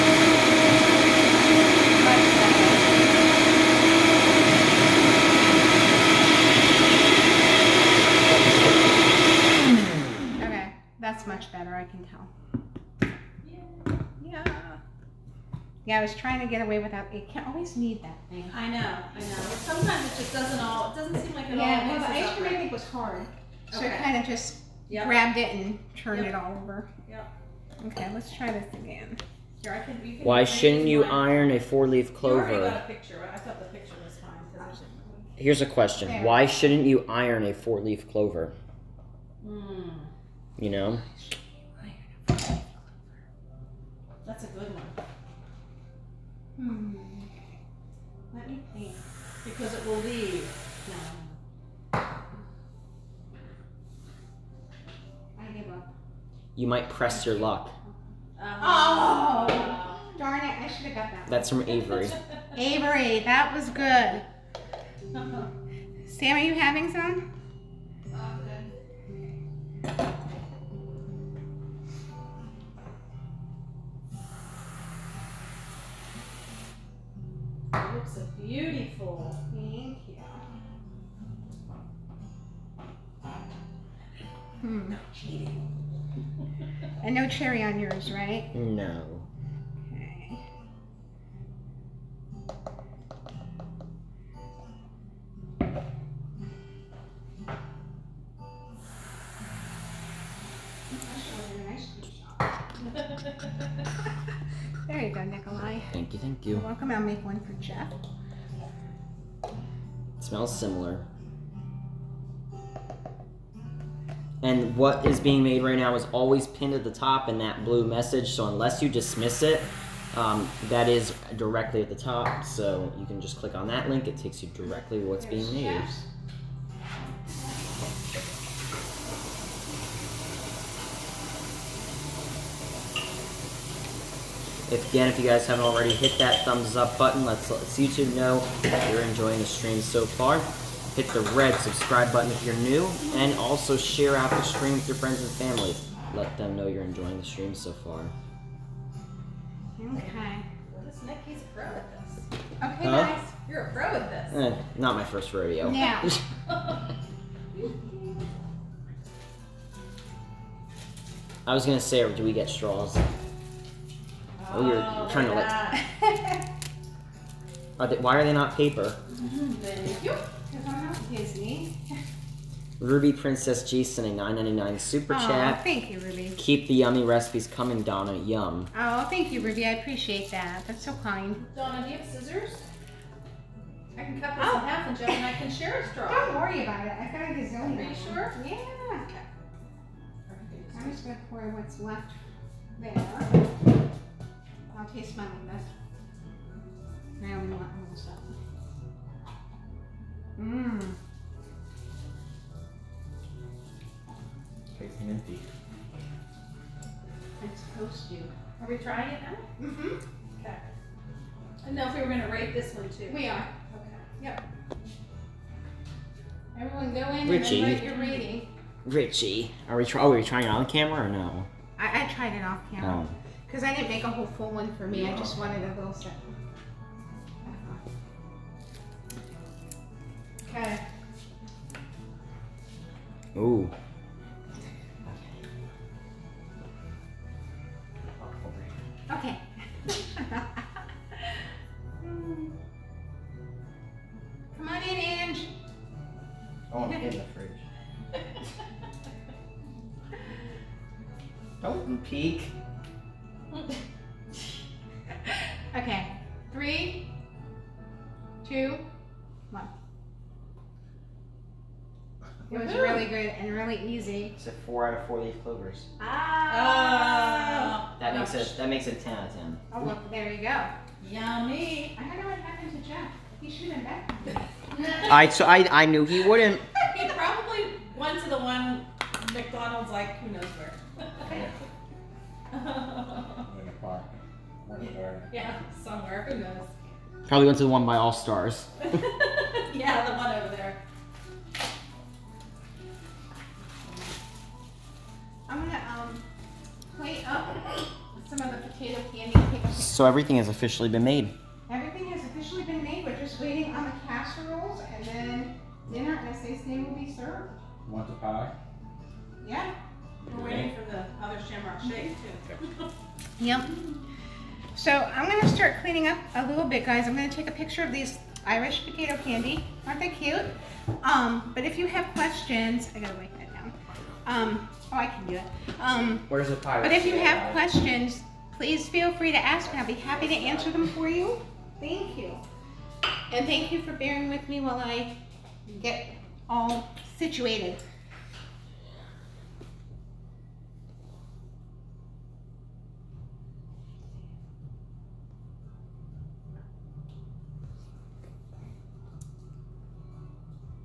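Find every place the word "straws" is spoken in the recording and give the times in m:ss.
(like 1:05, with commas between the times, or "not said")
2:42, 3:05.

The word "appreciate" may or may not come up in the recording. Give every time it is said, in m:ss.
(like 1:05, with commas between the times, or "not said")
2:59.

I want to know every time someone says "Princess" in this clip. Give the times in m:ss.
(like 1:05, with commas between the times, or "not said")
2:53.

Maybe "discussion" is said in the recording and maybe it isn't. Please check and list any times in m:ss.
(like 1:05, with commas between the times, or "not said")
not said.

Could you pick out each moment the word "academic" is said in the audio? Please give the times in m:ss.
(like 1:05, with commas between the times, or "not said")
not said.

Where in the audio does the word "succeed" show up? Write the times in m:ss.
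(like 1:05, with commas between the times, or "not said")
not said.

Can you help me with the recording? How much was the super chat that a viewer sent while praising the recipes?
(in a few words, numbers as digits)
9.99.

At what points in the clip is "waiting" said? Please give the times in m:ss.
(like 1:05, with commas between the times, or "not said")
5:03, 5:10.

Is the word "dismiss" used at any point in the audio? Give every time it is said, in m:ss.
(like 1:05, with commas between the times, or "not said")
1:58.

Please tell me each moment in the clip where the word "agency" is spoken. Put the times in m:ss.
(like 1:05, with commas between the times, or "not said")
not said.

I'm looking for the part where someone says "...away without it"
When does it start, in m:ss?
0:16.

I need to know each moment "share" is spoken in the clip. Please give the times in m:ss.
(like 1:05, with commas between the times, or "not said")
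2:23, 3:05.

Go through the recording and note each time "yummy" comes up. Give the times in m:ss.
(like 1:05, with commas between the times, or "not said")
2:56, 4:31.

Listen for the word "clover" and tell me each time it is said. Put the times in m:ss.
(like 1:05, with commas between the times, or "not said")
0:32, 0:38, 4:25.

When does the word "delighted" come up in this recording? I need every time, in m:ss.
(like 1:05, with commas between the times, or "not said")
not said.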